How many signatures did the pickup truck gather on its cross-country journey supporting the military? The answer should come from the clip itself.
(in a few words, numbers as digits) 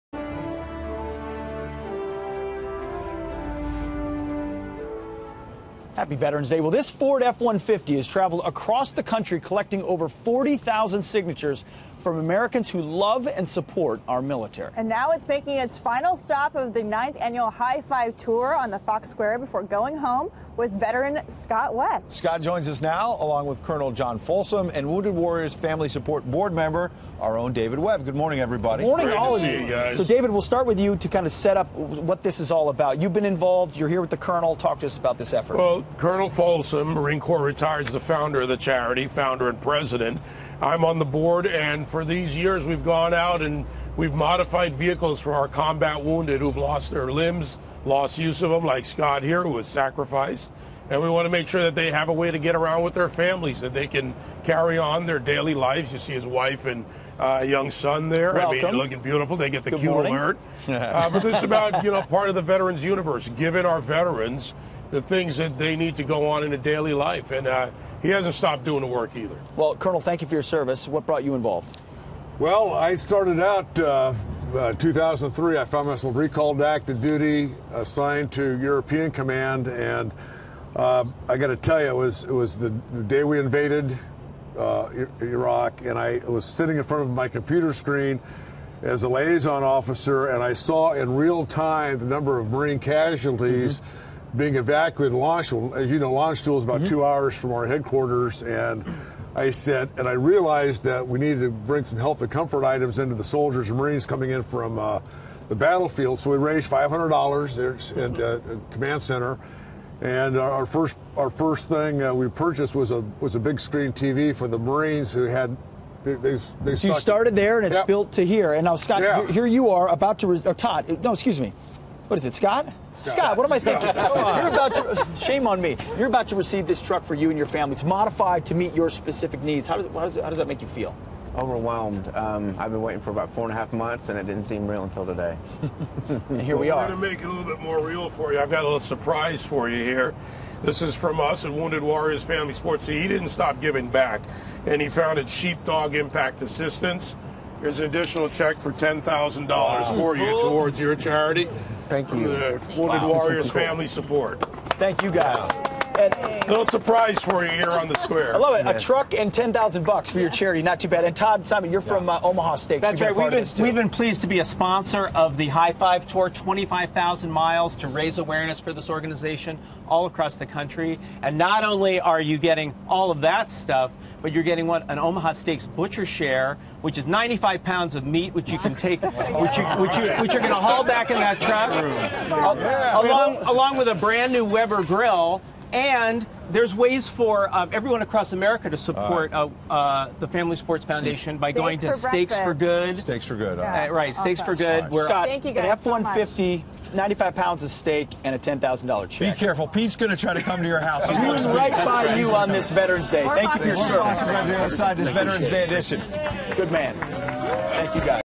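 over 40,000.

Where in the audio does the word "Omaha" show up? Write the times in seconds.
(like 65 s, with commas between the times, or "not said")
162 s, 174 s.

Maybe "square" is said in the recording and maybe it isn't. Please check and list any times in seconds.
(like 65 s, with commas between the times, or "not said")
19 s, 157 s.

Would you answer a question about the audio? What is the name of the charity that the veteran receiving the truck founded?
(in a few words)
Sheepdog Impact Assistance.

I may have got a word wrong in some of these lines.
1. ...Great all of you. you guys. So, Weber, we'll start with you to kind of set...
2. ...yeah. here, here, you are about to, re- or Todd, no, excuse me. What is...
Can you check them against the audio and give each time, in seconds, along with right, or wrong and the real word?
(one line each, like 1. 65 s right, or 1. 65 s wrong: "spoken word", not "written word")
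1. 29 s wrong: "David", not "Weber"
2. 119 s right.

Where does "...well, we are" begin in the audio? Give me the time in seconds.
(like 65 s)
136 s.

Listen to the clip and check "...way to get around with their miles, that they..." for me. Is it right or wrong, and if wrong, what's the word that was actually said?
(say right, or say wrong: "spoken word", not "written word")
wrong: "families", not "miles".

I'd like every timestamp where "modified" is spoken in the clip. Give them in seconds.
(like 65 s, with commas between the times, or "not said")
44 s, 127 s.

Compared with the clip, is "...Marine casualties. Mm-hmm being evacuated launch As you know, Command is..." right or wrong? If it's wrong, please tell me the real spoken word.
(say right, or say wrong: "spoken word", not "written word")
wrong: "Landstuhl", not "Command".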